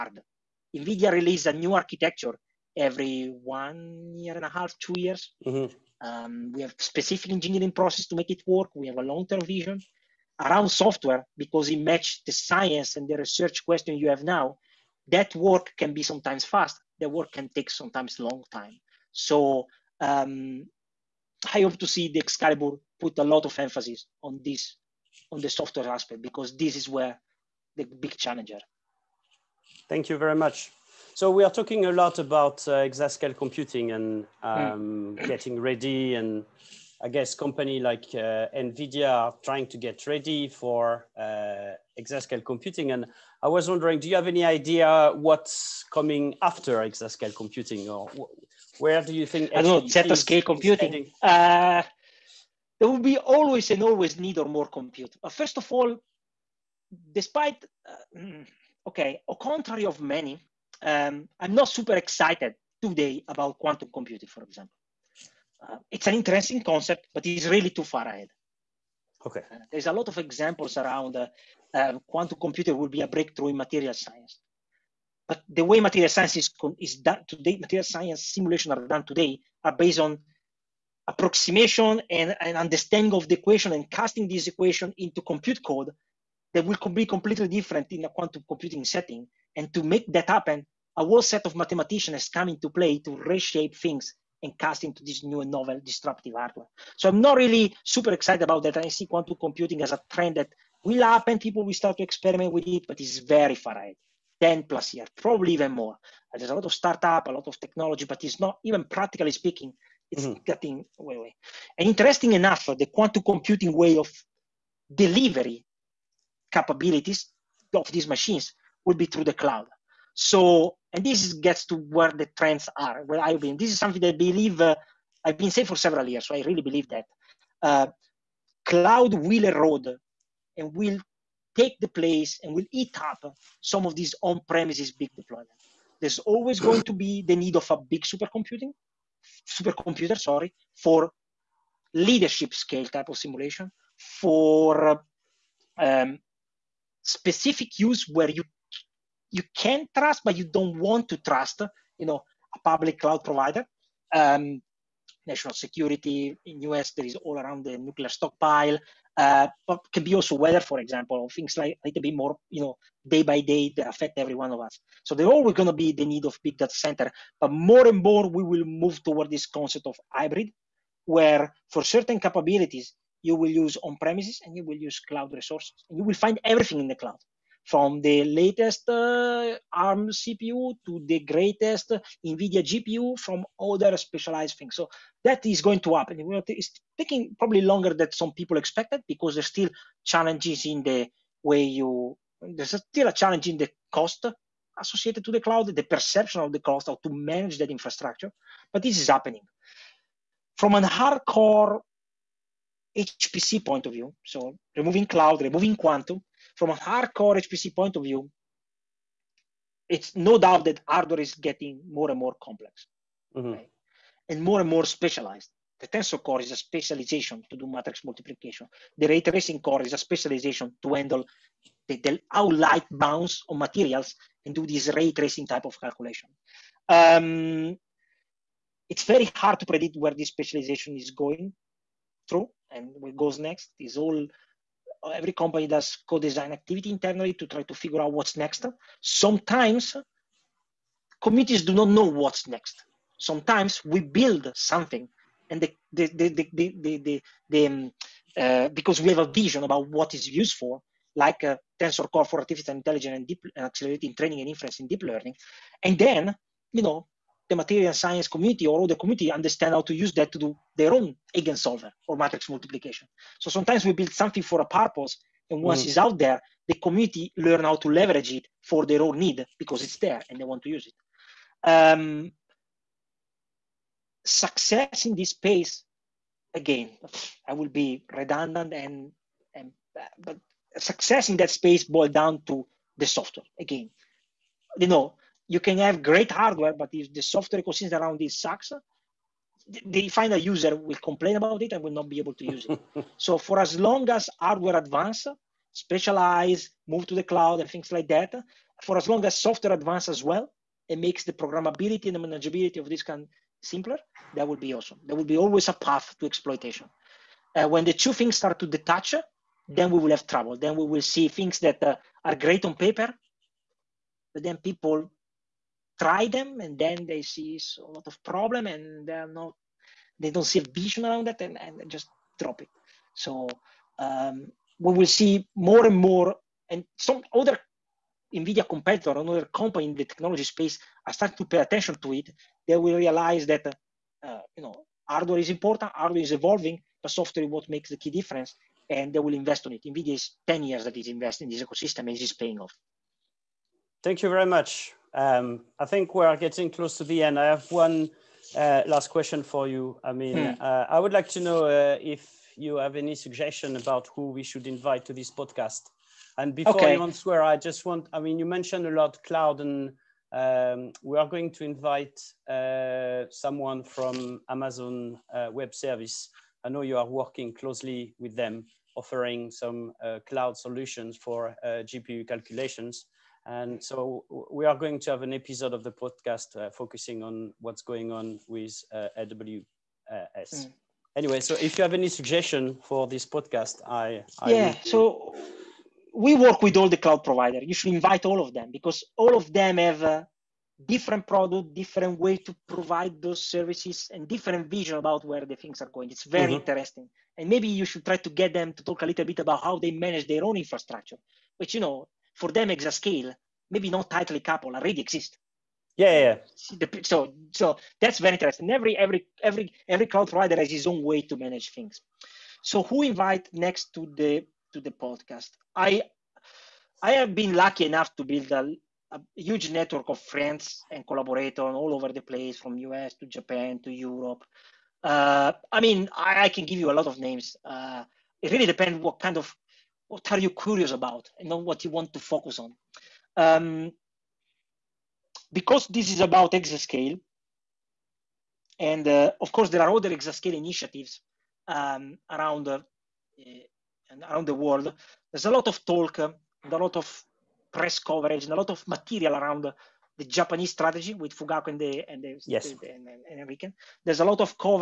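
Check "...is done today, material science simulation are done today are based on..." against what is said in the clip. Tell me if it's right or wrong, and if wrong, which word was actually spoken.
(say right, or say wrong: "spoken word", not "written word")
right.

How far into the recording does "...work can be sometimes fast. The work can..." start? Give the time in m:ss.
0:15.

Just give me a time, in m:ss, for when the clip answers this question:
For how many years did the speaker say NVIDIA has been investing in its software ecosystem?
5:40.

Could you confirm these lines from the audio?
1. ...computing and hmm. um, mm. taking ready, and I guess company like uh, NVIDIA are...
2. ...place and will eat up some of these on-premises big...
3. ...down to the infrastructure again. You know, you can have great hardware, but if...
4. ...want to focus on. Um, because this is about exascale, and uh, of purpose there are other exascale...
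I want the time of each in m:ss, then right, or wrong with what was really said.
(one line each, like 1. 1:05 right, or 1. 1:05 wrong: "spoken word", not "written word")
1. 0:33 wrong: "getting", not "taking"
2. 2:11 right
3. 4:42 wrong: "software", not "infrastructure"
4. 7:11 wrong: "course", not "purpose".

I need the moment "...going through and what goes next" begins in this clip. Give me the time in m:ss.
3:51.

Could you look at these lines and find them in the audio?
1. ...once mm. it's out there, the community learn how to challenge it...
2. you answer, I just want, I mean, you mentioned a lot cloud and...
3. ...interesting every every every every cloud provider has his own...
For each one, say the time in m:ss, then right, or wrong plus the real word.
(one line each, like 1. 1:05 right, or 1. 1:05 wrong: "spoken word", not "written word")
1. 4:25 wrong: "leverage", not "challenge"
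2. 5:56 right
3. 6:48 right.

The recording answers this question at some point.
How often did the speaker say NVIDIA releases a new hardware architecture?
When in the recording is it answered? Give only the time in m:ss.
0:02.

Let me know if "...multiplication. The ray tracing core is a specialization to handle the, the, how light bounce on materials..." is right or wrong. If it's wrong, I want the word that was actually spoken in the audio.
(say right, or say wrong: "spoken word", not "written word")
right.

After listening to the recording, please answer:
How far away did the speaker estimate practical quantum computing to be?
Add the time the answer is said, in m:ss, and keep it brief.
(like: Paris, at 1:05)
10 plus years, at 1:44.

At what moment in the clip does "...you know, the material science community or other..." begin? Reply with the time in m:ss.
4:16.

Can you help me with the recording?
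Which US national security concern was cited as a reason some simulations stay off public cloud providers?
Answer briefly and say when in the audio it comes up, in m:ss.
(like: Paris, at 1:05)
Nuclear stockpile, at 2:37.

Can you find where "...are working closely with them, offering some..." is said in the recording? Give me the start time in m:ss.
6:06.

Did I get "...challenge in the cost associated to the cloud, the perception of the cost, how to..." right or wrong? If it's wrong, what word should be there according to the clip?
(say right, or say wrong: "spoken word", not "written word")
right.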